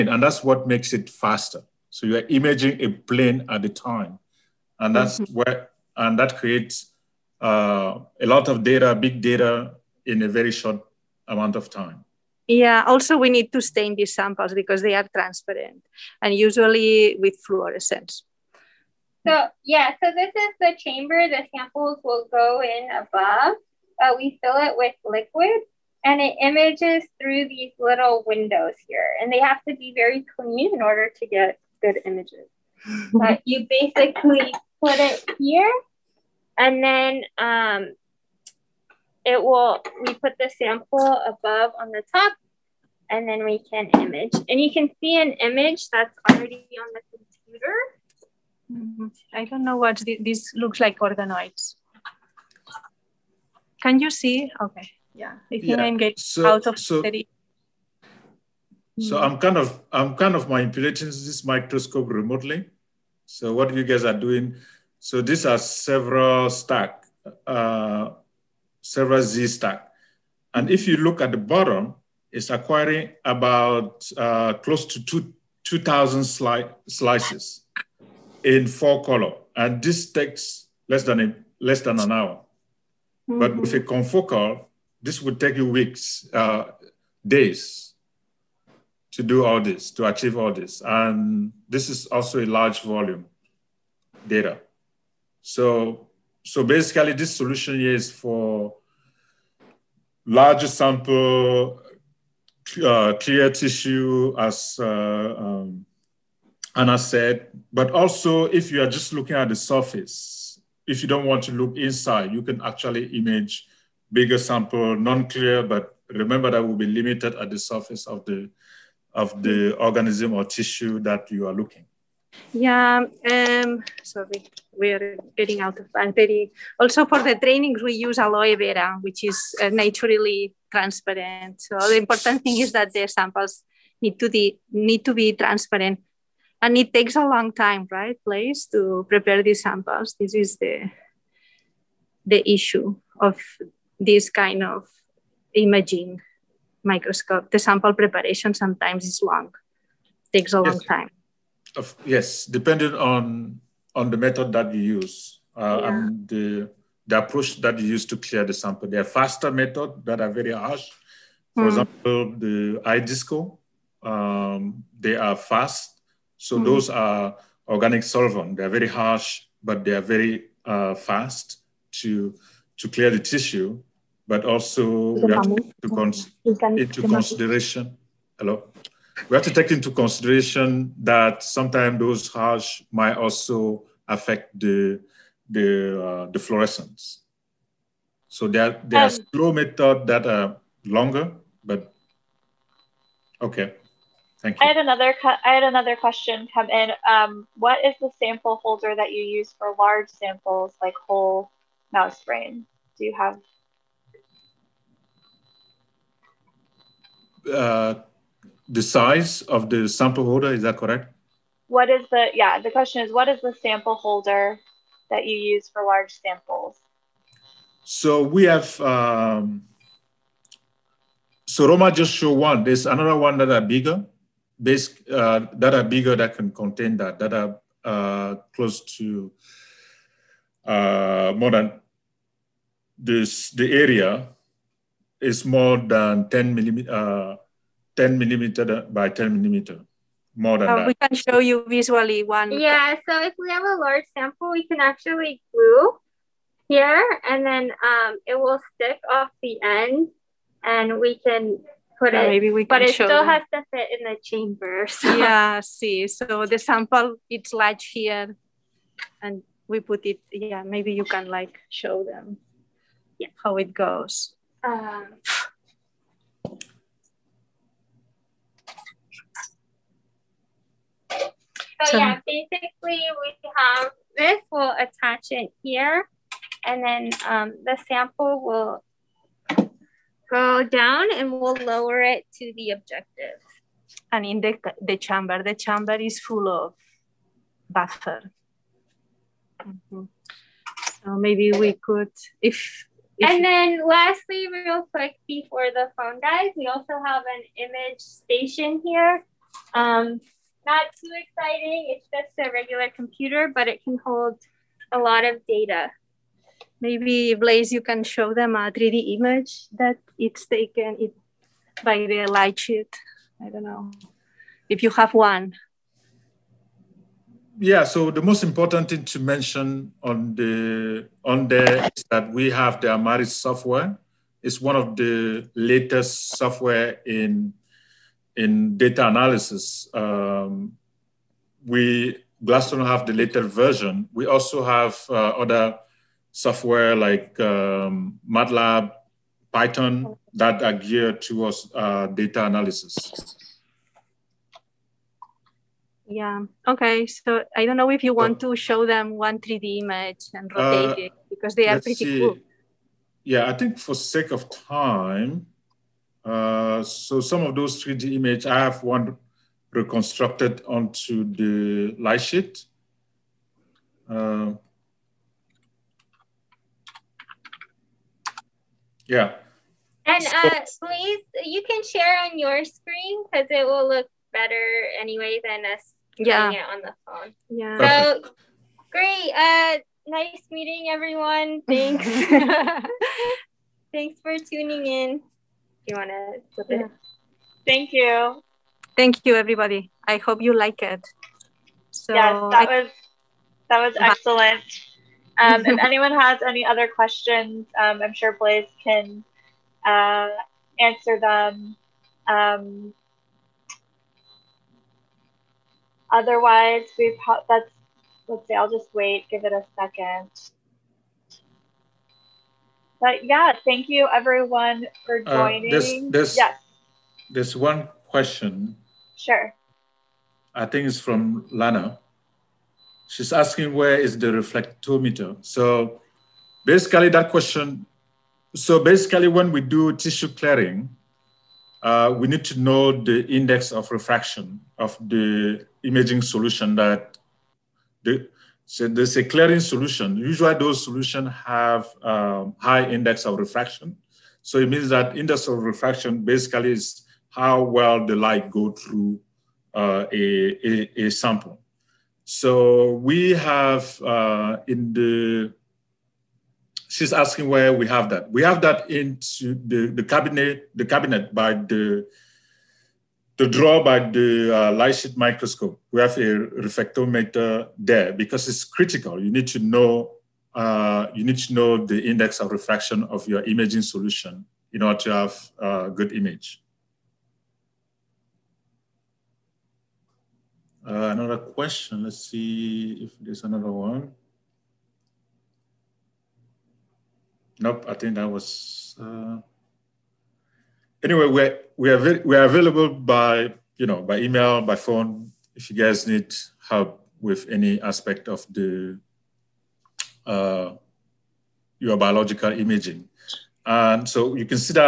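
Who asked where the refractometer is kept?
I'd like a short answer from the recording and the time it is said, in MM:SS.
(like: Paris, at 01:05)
Lana, at 07:01.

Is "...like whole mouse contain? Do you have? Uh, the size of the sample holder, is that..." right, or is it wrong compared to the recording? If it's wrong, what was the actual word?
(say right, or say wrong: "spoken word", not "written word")
wrong: "brain", not "contain".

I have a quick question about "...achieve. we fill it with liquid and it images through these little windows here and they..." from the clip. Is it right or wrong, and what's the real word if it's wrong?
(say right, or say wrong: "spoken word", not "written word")
wrong: "above", not "achieve".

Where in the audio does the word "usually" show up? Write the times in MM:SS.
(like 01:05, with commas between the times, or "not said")
00:16, 07:20.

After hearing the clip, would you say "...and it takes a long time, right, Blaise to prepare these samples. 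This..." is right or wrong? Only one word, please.
right.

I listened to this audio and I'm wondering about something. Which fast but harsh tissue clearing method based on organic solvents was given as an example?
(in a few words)
iDISCO.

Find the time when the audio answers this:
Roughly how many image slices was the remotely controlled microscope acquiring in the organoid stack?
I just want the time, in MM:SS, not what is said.
01:15.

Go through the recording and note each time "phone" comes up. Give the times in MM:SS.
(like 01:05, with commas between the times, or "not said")
04:55, 06:17, 08:14.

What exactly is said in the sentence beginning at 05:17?
Yeah, so the most important thing to mention on the on there is that we have the Imaris software.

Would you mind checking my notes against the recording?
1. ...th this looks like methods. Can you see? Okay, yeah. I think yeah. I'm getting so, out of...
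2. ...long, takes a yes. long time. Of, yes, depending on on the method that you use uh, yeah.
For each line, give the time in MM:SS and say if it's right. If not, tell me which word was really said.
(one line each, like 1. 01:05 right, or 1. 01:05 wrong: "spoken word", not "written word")
1. 00:50 wrong: "organoids", not "methods"
2. 02:29 right.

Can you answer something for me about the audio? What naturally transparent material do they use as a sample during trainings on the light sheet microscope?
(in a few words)
aloe vera.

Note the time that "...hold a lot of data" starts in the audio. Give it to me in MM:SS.
05:04.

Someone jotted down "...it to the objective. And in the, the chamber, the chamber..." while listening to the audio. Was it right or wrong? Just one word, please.
right.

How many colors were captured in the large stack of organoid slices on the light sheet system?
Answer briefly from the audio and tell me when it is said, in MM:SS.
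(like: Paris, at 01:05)
4, at 01:18.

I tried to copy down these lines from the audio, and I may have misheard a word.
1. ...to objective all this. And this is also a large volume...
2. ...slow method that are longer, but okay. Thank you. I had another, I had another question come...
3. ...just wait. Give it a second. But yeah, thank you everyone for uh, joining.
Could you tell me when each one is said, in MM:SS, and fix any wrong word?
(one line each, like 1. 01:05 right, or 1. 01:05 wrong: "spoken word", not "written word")
1. 01:29 wrong: "achieve", not "objective"
2. 03:09 right
3. 06:48 right.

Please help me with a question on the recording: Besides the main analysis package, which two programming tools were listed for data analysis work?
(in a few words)
MATLAB, Python.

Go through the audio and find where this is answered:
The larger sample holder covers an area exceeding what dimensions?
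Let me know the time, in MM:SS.
03:57.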